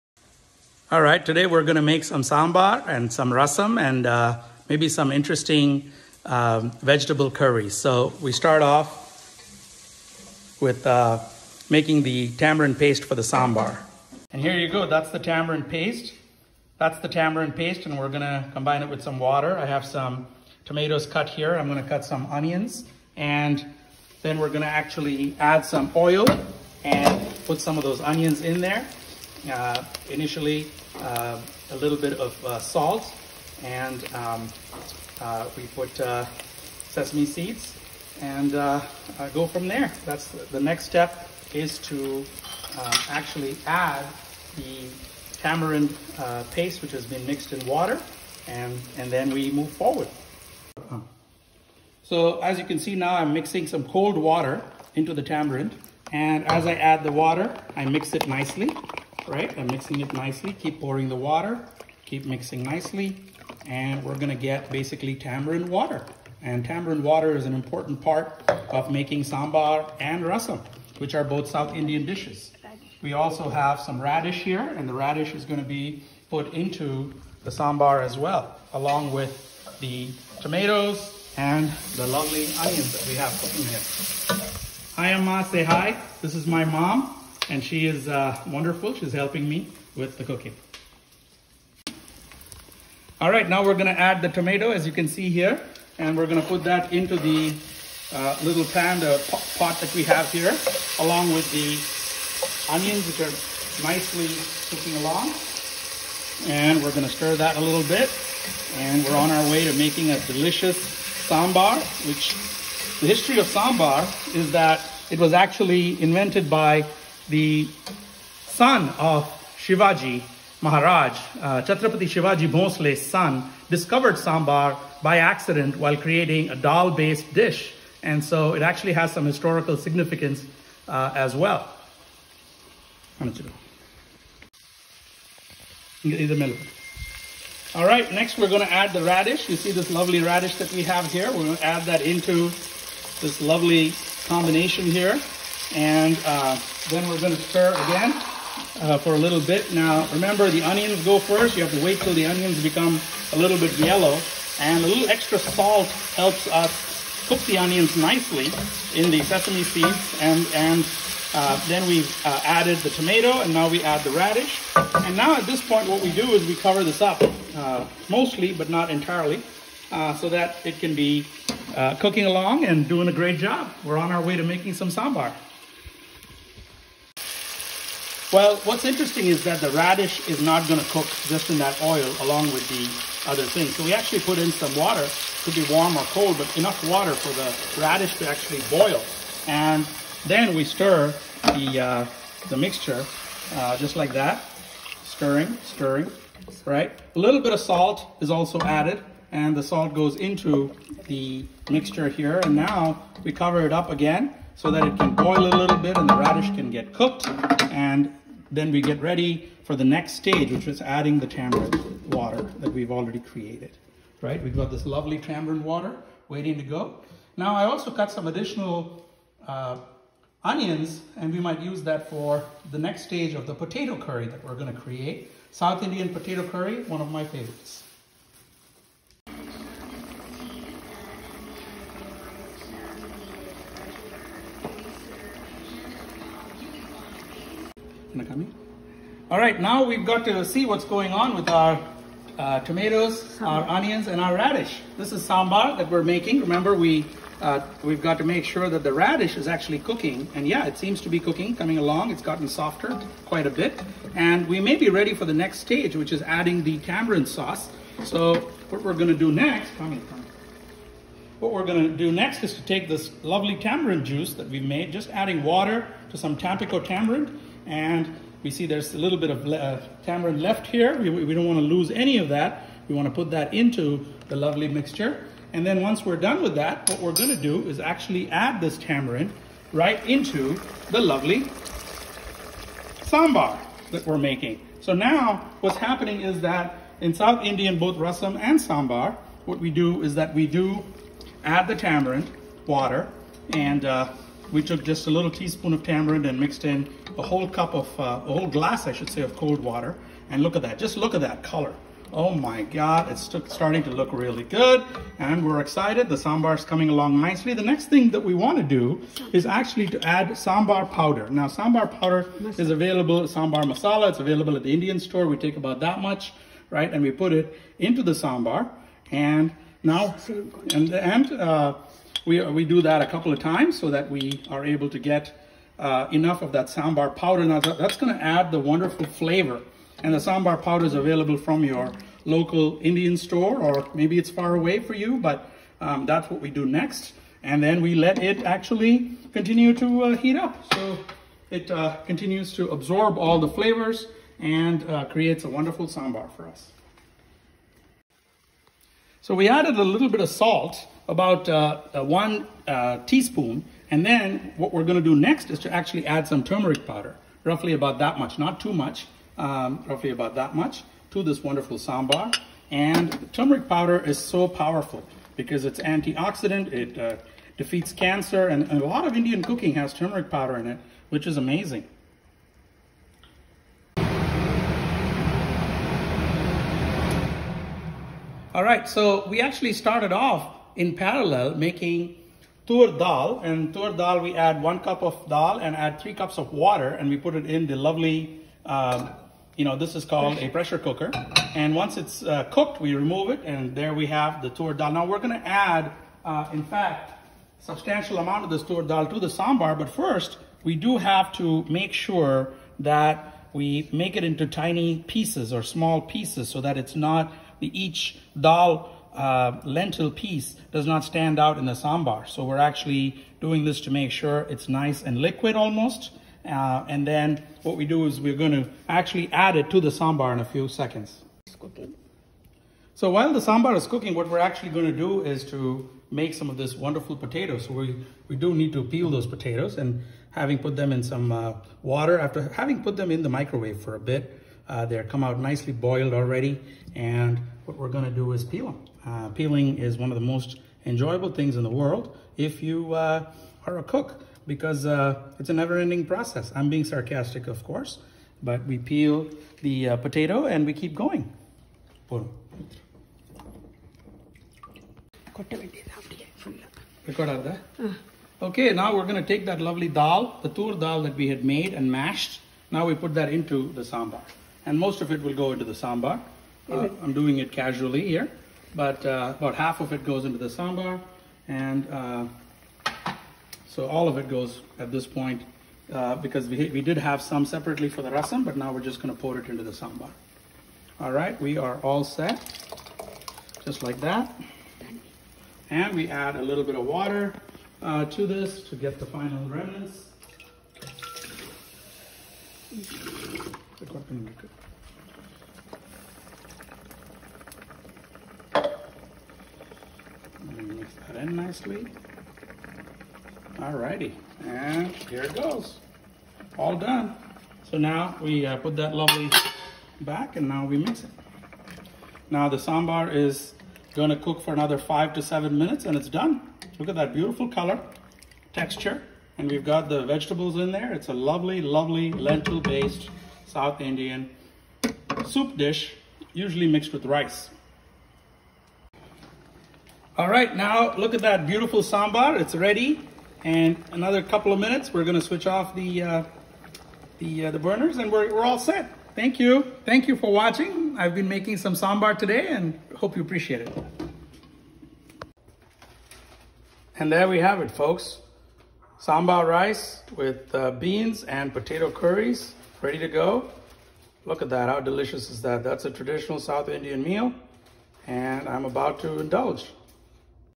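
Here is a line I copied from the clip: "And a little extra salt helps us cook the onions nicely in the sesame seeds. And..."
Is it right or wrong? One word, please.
right.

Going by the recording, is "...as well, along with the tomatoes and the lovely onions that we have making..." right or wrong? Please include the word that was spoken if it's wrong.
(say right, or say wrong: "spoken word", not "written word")
wrong: "cooking", not "making".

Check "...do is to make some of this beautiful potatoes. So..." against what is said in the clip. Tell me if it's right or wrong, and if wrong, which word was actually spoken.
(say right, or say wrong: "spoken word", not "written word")
wrong: "wonderful", not "beautiful".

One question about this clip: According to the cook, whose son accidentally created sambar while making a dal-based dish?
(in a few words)
Shivaji Maharaj.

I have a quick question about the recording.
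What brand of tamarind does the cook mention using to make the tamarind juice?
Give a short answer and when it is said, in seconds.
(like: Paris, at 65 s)
Tampico, at 266 s.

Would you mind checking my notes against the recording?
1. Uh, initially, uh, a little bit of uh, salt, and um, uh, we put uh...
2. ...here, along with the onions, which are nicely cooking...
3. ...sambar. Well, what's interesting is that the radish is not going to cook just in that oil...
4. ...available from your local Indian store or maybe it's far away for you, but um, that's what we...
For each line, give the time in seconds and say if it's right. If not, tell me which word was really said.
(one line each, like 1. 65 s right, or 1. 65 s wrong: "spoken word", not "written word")
1. 29 s right
2. 100 s right
3. 174 s right
4. 330 s right.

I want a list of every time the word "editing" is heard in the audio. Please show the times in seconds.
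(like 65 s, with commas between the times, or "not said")
not said.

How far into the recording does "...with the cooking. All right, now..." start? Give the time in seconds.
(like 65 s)
89 s.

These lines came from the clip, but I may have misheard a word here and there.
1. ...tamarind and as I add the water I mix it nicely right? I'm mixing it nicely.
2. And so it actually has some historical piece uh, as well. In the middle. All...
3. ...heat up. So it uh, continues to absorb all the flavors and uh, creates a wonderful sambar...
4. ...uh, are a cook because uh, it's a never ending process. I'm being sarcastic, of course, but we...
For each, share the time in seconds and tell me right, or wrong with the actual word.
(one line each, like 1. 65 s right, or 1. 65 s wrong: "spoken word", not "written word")
1. 55 s right
2. 128 s wrong: "significance", not "piece"
3. 340 s right
4. 442 s right.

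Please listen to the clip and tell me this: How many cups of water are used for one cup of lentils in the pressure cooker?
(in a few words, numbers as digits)
3 cups.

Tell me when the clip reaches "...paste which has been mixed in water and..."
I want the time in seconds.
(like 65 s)
46 s.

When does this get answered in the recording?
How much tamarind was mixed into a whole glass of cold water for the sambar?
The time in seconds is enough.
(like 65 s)
295 s.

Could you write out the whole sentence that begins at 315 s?
We take about that much, right?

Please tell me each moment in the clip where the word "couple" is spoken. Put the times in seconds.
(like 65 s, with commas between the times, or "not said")
323 s, 534 s.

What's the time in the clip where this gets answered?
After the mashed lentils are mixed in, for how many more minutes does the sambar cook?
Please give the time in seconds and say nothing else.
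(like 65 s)
514 s.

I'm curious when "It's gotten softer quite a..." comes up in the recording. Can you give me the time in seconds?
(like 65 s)
252 s.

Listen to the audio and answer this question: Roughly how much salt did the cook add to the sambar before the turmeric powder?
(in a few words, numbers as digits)
1 teaspoon.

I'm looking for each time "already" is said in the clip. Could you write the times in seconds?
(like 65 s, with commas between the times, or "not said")
212 s, 436 s.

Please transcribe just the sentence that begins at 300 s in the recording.
And look at that, just look at that color.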